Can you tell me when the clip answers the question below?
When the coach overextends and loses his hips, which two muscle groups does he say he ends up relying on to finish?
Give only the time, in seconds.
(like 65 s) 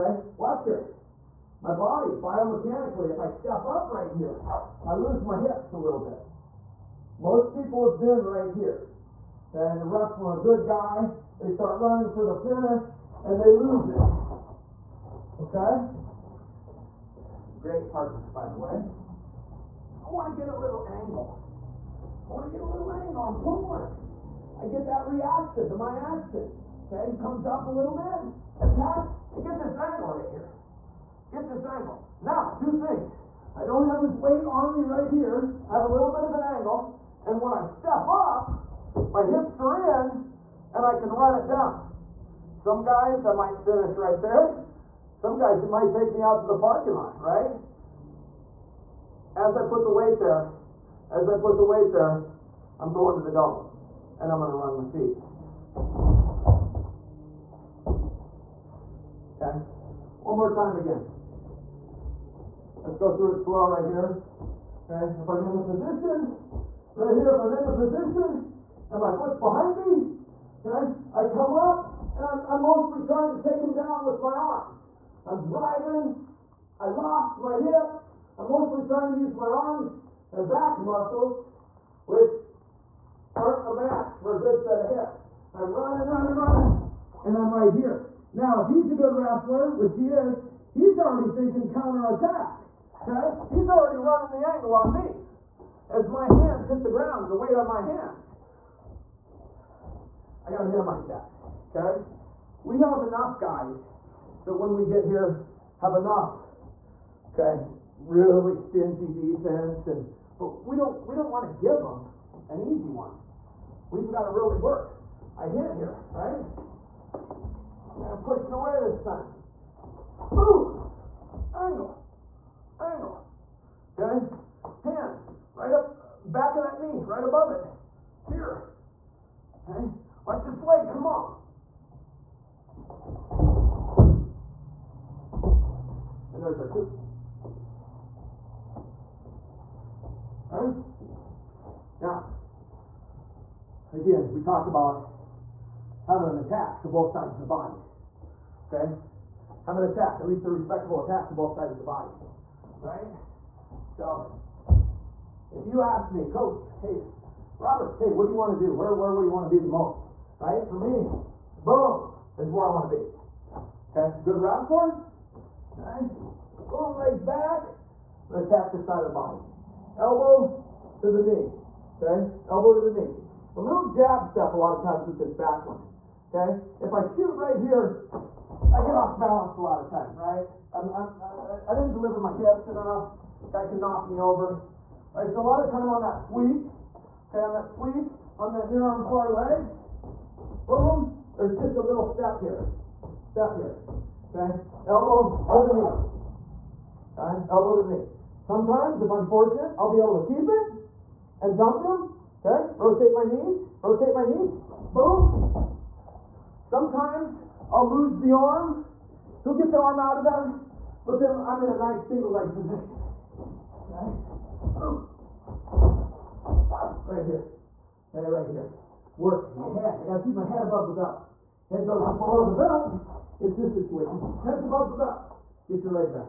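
79 s.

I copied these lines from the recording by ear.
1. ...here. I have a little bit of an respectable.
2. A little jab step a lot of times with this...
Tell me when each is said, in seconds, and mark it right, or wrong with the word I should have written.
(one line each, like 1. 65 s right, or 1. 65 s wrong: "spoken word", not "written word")
1. 35 s wrong: "angle", not "respectable"
2. 173 s right.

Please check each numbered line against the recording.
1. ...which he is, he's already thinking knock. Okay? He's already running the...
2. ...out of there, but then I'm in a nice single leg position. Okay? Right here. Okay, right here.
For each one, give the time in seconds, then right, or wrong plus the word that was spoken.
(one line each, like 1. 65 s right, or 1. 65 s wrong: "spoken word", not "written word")
1. 89 s wrong: "counterattack", not "knock"
2. 209 s right.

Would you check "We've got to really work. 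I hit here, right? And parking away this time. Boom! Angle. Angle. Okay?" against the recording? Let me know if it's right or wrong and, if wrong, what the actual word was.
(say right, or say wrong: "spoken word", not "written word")
wrong: "pushing", not "parking".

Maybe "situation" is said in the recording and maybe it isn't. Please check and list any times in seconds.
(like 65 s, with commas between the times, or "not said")
223 s.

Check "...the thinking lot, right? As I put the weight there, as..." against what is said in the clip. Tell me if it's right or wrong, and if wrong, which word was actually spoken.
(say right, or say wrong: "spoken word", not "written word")
wrong: "parking", not "thinking".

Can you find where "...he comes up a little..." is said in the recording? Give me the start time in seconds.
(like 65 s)
27 s.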